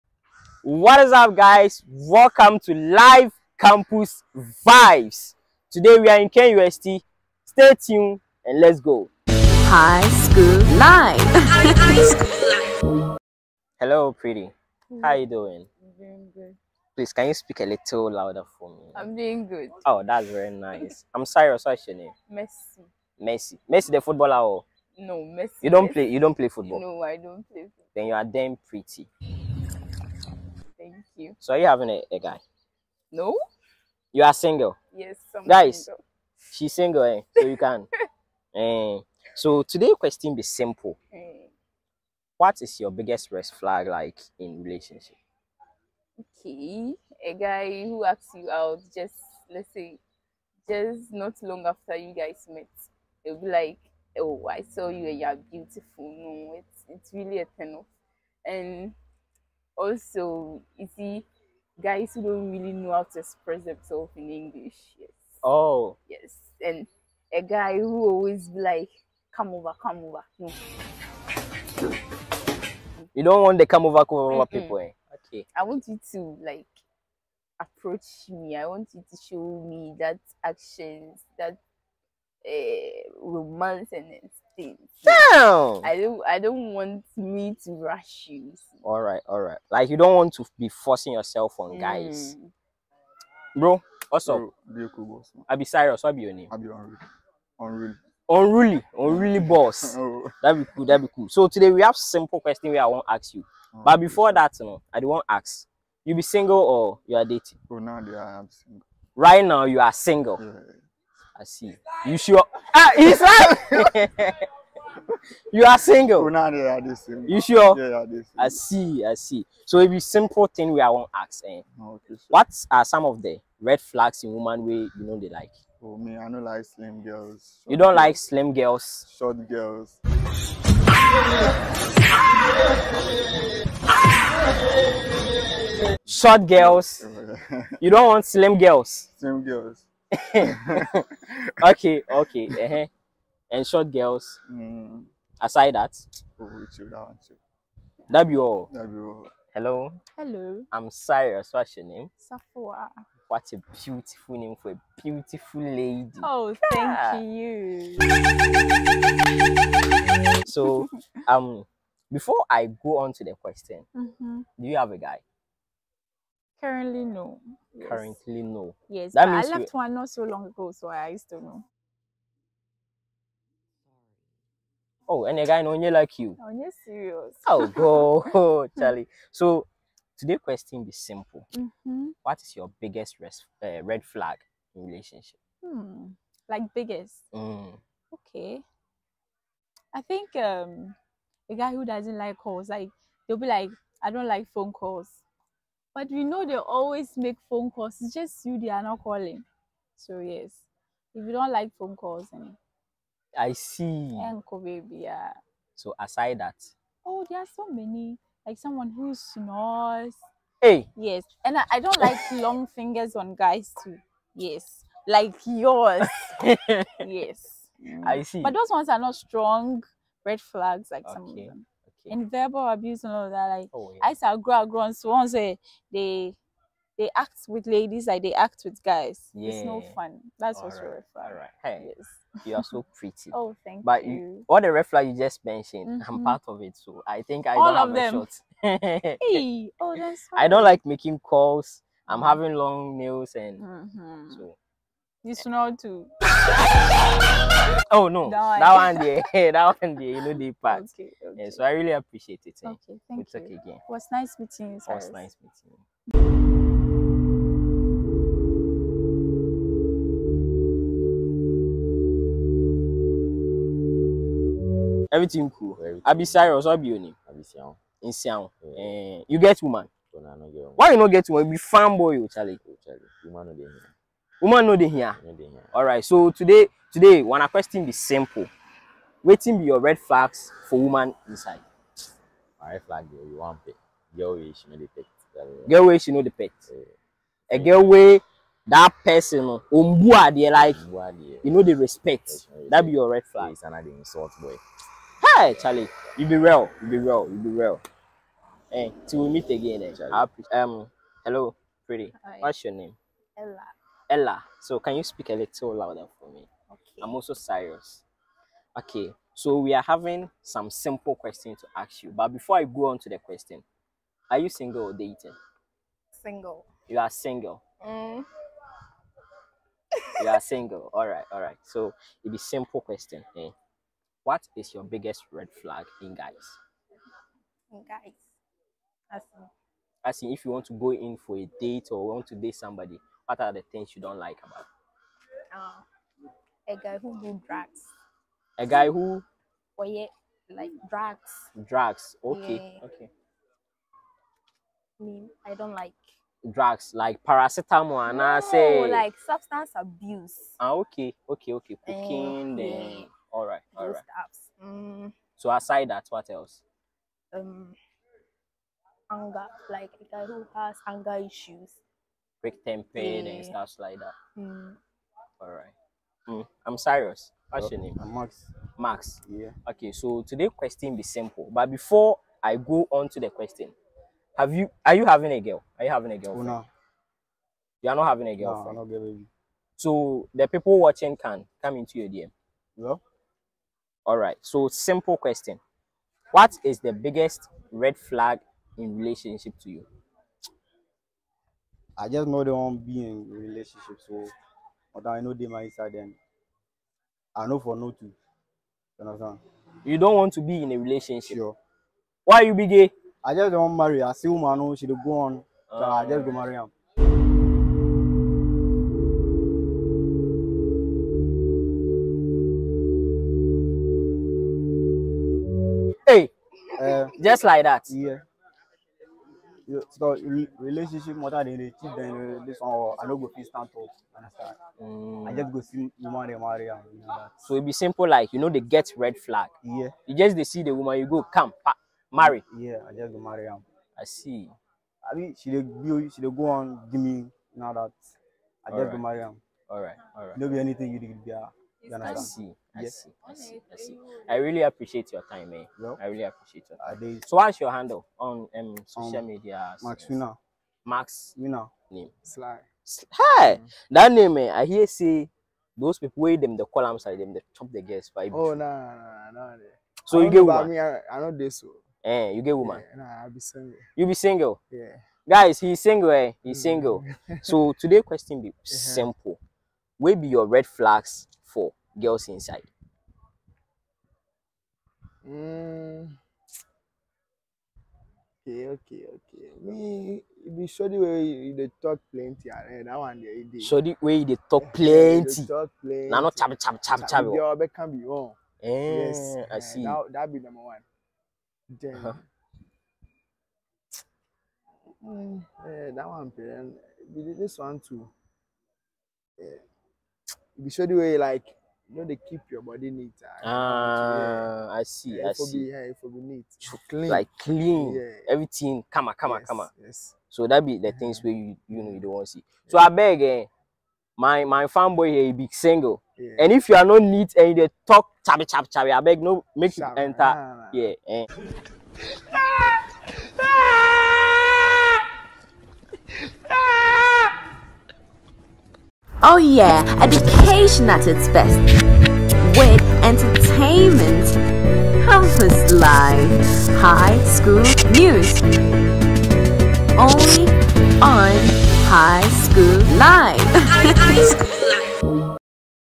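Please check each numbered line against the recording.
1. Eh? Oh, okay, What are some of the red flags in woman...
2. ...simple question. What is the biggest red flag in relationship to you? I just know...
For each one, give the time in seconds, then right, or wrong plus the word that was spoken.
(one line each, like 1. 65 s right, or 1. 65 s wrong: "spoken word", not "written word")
1. 121 s right
2. 384 s right.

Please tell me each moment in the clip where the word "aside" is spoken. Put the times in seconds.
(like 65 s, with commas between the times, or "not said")
145 s, 205 s, 355 s.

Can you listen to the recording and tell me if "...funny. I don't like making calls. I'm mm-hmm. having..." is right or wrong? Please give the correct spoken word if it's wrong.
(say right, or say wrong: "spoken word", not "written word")
right.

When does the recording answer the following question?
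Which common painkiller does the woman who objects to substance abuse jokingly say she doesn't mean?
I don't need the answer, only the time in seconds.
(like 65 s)
347 s.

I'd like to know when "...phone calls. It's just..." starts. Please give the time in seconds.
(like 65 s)
197 s.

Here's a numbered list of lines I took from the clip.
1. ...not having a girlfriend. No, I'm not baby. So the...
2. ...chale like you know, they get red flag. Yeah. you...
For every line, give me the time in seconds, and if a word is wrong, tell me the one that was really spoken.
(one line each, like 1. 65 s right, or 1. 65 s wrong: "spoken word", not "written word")
1. 377 s right
2. 427 s wrong: "simple", not "chale".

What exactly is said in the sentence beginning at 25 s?
no messi you don't play you don't play football no i don't play football.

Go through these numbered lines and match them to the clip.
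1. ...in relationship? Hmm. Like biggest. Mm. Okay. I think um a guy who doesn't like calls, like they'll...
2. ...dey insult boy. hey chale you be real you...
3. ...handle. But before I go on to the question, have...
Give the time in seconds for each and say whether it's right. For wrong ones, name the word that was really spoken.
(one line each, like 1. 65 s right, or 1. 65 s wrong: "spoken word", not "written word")
1. 184 s right
2. 293 s right
3. 371 s wrong: "simple", not "handle".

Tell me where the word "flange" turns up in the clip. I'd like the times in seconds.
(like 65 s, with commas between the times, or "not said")
not said.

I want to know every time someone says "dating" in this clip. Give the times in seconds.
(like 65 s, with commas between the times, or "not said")
107 s, 314 s.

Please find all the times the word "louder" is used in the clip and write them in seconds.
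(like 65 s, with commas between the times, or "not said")
18 s, 305 s.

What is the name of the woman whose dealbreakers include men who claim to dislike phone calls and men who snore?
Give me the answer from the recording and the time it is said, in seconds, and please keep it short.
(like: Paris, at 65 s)
Safwa, at 152 s.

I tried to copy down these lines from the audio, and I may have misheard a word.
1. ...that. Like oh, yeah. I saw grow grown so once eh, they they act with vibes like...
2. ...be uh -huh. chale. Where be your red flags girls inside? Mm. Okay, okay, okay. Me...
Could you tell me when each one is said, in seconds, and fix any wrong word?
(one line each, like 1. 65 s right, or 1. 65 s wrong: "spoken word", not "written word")
1. 223 s wrong: "ladies", not "vibes"
2. 468 s wrong: "simple", not "chale".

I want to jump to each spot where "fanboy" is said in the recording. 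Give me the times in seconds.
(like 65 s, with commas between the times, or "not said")
271 s, 514 s.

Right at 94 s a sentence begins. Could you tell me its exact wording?
Bro, I'll be Cyrus, what be your name?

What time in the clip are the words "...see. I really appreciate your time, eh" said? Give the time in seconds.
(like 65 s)
443 s.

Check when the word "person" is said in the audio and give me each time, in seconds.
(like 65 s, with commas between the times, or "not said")
289 s.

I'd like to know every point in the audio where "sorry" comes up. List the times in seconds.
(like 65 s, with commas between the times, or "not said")
21 s.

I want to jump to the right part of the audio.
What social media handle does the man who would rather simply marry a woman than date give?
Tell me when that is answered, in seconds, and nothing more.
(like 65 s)
449 s.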